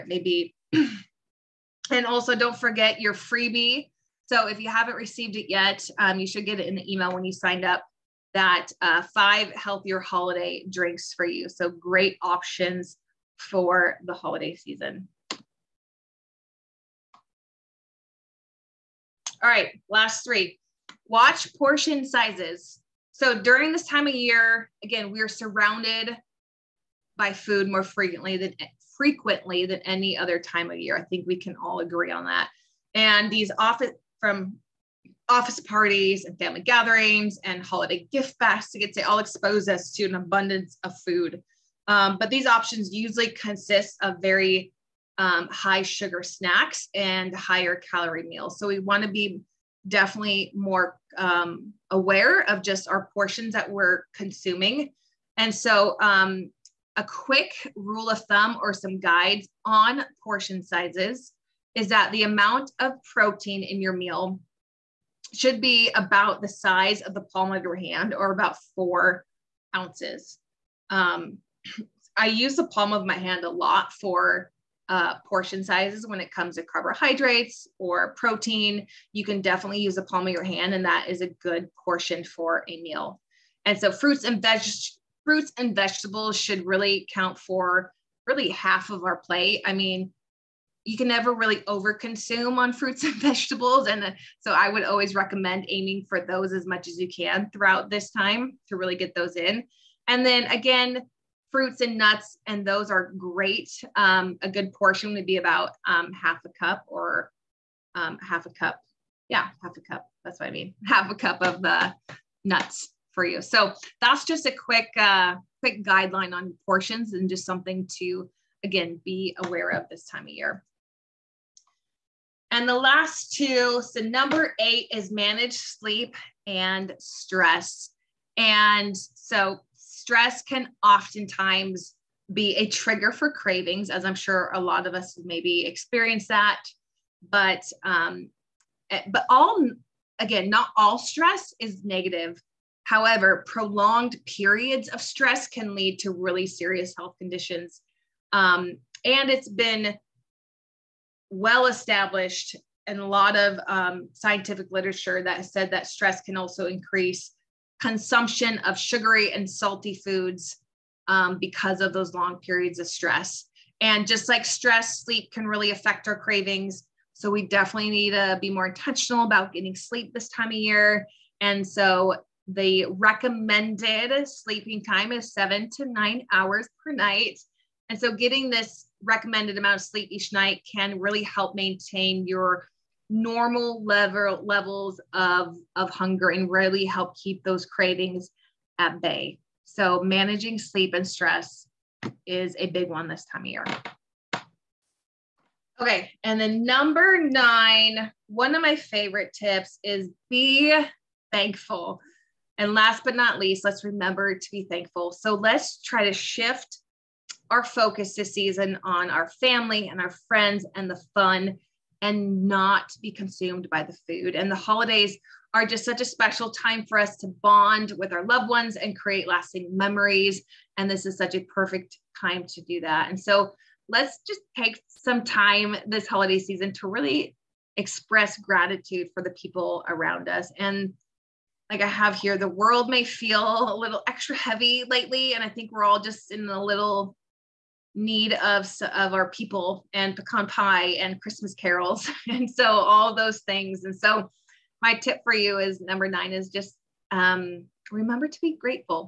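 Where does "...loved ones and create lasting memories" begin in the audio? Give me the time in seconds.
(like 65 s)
218 s.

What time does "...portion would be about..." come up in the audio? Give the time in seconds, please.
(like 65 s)
104 s.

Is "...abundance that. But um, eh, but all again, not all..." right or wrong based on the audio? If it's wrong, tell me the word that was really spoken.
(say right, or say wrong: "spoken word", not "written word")
wrong: "experience", not "abundance".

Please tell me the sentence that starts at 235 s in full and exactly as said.
And I think we're all just in a little need of, of our people and pecan pie and Christmas carols.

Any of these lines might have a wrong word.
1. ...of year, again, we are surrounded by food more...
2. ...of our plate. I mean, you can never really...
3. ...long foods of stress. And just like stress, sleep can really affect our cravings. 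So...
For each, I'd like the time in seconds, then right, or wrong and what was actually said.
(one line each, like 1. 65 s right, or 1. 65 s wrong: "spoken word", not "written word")
1. 24 s right
2. 88 s right
3. 162 s wrong: "periods", not "foods".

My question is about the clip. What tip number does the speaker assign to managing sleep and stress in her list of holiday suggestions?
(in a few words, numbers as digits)
8.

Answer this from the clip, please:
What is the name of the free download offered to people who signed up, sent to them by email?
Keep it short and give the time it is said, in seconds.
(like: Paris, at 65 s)
five healthier holiday drinks, at 9 s.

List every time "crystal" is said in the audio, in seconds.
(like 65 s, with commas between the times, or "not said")
not said.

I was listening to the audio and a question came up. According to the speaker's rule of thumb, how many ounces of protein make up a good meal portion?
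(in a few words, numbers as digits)
4 ounces.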